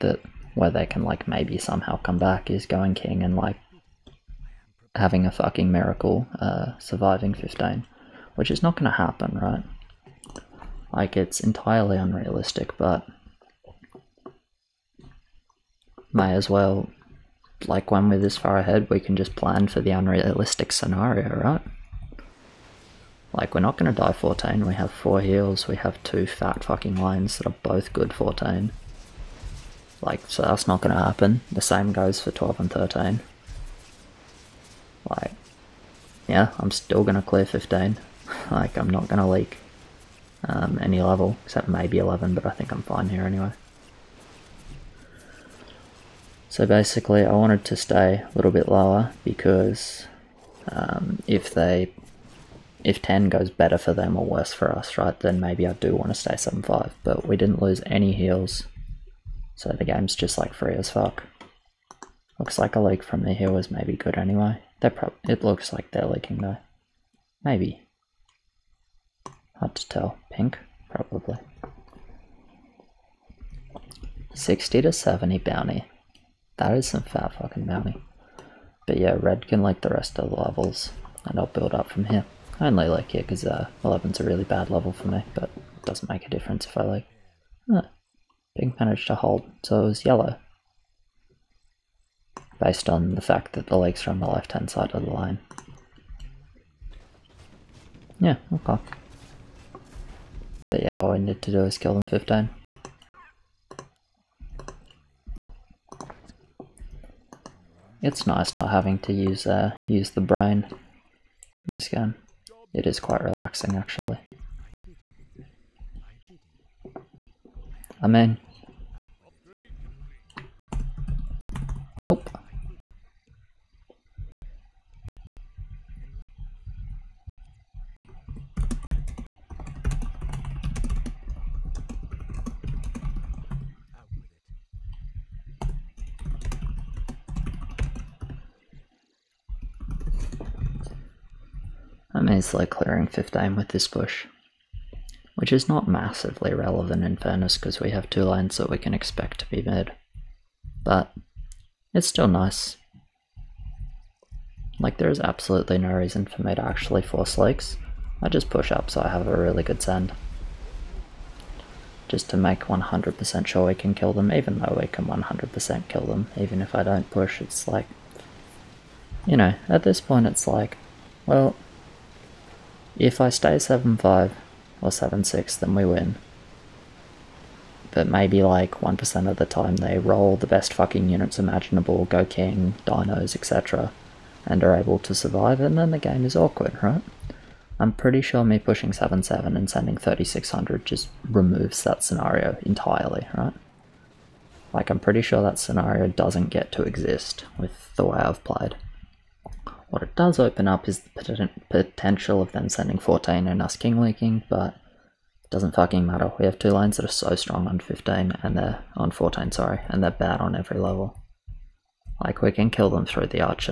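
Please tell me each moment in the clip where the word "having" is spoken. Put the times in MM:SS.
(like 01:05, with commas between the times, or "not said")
00:04, 01:48.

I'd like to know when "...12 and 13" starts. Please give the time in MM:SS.
00:32.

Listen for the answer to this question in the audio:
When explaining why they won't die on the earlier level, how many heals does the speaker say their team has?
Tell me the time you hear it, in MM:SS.
00:24.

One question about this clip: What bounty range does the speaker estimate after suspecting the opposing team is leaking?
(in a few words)
60 to 70.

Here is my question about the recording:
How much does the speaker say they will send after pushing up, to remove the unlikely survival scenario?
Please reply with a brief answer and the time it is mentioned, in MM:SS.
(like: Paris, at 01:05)
3600, at 03:09.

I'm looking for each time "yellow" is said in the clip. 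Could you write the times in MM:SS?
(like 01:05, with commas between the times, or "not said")
01:30.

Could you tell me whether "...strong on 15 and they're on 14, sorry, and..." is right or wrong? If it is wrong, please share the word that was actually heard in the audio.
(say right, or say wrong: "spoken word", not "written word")
right.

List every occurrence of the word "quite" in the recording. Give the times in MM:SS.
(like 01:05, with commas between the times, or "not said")
01:53.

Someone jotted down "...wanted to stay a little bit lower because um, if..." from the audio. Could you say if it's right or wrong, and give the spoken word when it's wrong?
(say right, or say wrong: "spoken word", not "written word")
right.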